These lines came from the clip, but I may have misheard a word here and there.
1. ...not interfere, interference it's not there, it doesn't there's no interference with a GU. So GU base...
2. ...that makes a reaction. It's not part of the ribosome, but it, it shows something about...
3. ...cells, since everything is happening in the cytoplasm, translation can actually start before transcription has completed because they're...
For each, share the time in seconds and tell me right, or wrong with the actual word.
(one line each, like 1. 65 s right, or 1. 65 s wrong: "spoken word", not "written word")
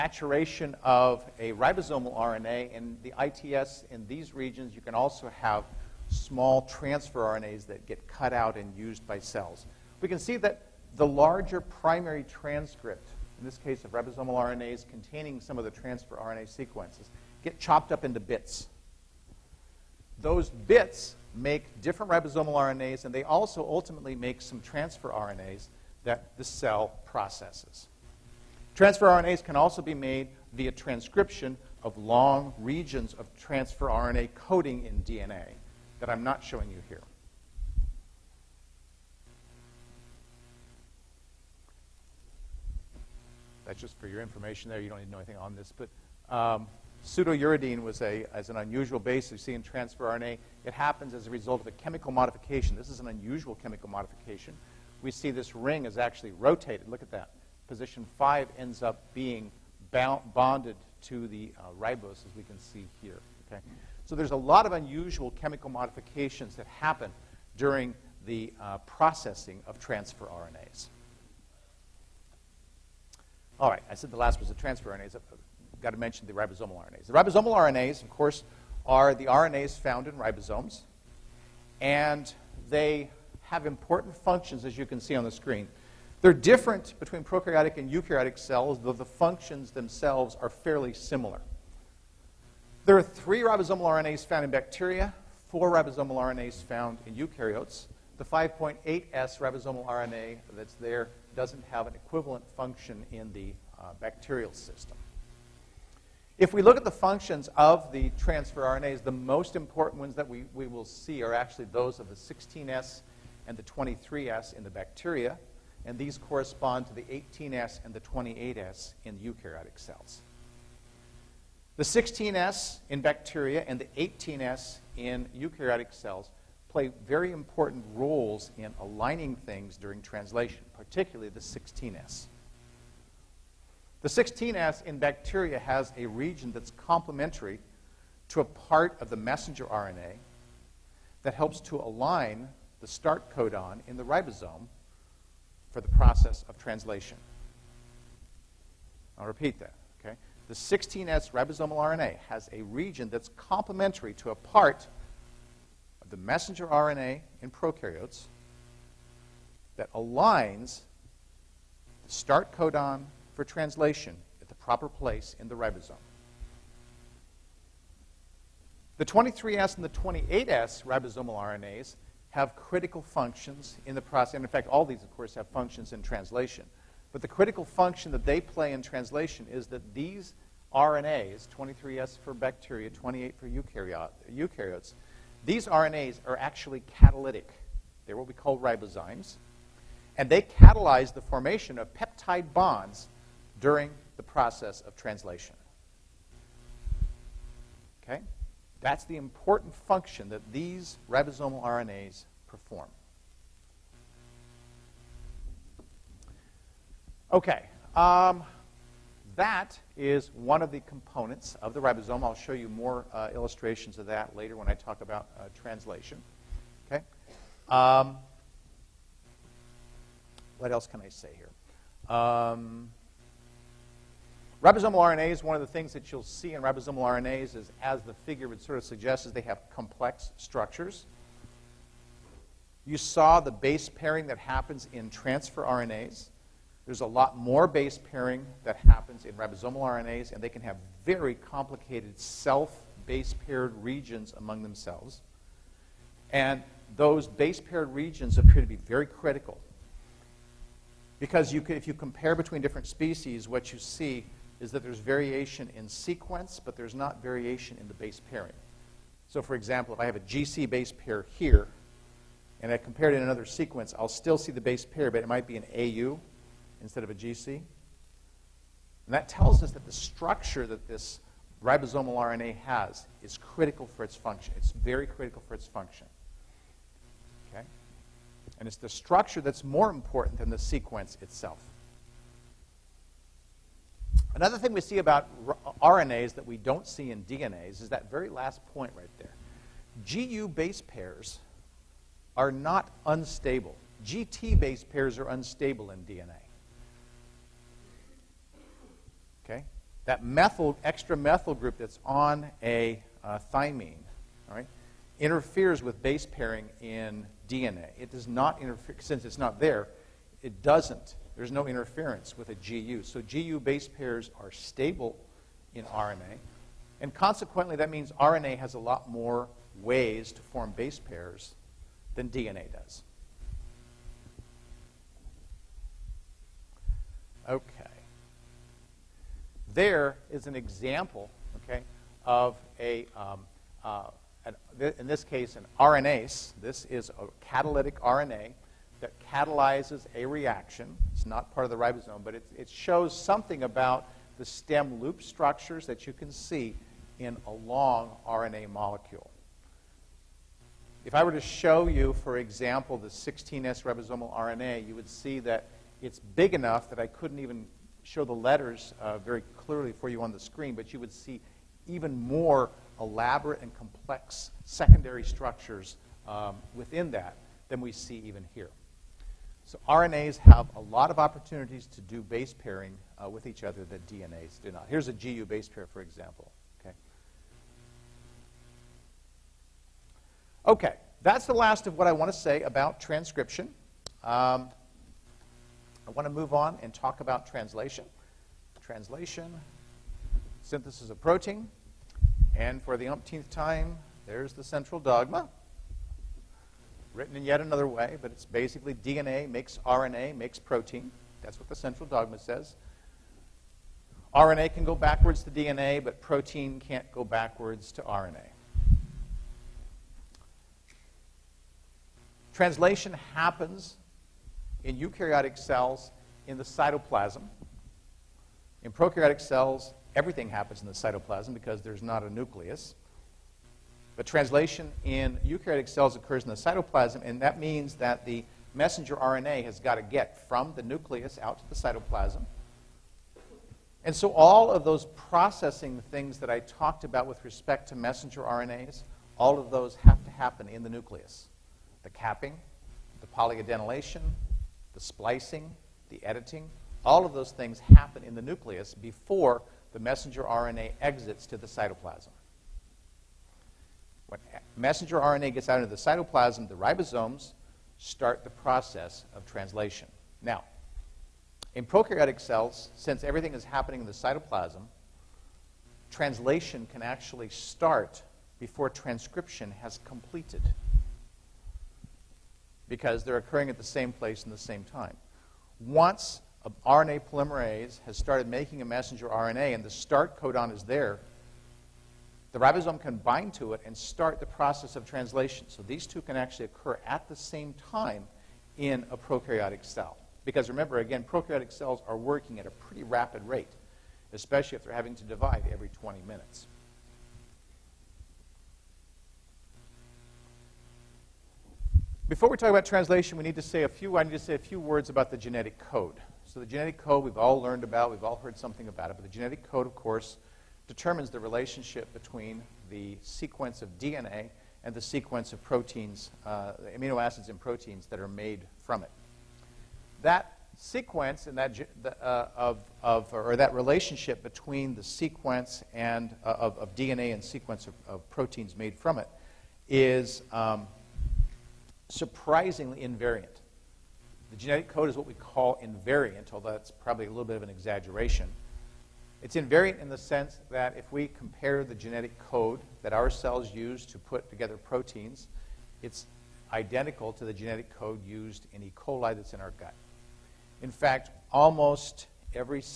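1. 308 s wrong: "since", not "interference"
2. 338 s wrong: "catalyzes", not "makes"
3. 462 s right.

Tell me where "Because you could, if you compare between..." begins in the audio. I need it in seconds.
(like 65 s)
251 s.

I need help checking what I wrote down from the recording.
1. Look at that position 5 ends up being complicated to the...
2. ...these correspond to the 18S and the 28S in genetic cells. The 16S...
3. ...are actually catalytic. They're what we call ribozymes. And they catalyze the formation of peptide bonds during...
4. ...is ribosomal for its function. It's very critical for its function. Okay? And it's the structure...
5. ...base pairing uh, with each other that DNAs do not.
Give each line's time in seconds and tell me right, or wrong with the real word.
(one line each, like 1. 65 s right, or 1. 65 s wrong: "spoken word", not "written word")
1. 56 s wrong: "bonded", not "complicated"
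2. 115 s wrong: "eukaryotic", not "genetic"
3. 186 s right
4. 273 s wrong: "critical", not "ribosomal"
5. 372 s right.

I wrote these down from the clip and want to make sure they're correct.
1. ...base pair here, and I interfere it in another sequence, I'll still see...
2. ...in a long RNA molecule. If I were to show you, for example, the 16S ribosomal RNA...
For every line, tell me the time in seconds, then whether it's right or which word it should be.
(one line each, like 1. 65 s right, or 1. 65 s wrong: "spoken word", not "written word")
1. 260 s wrong: "compare", not "interfere"
2. 347 s right.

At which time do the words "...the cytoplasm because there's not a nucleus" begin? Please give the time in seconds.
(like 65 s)
420 s.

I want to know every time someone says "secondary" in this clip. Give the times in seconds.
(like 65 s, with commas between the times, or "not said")
364 s.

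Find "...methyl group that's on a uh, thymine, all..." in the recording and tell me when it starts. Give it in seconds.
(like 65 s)
301 s.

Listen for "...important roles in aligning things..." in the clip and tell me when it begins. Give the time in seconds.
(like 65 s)
127 s.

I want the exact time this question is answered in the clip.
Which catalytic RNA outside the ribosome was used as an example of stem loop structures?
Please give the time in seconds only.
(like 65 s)
335 s.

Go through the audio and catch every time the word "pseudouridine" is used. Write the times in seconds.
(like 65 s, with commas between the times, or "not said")
47 s.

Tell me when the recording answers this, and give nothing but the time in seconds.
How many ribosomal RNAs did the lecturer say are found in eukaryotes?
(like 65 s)
95 s.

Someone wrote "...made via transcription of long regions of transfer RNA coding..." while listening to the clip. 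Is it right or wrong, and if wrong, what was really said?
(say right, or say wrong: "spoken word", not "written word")
right.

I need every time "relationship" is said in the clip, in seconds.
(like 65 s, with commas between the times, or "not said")
511 s, 523 s.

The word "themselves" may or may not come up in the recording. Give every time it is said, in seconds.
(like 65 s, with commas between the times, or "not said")
89 s, 244 s.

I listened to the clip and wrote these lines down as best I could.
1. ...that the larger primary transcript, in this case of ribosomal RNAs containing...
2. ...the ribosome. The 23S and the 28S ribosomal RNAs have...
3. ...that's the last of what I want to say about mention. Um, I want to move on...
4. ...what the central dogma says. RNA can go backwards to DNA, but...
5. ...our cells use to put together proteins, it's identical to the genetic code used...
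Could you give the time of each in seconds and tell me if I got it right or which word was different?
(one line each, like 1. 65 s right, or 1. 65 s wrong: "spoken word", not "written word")
1. 10 s right
2. 165 s right
3. 381 s wrong: "transcription", not "mention"
4. 401 s right
5. 543 s right.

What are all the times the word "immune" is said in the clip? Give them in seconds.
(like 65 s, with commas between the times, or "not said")
not said.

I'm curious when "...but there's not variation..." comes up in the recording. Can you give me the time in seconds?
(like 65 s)
256 s.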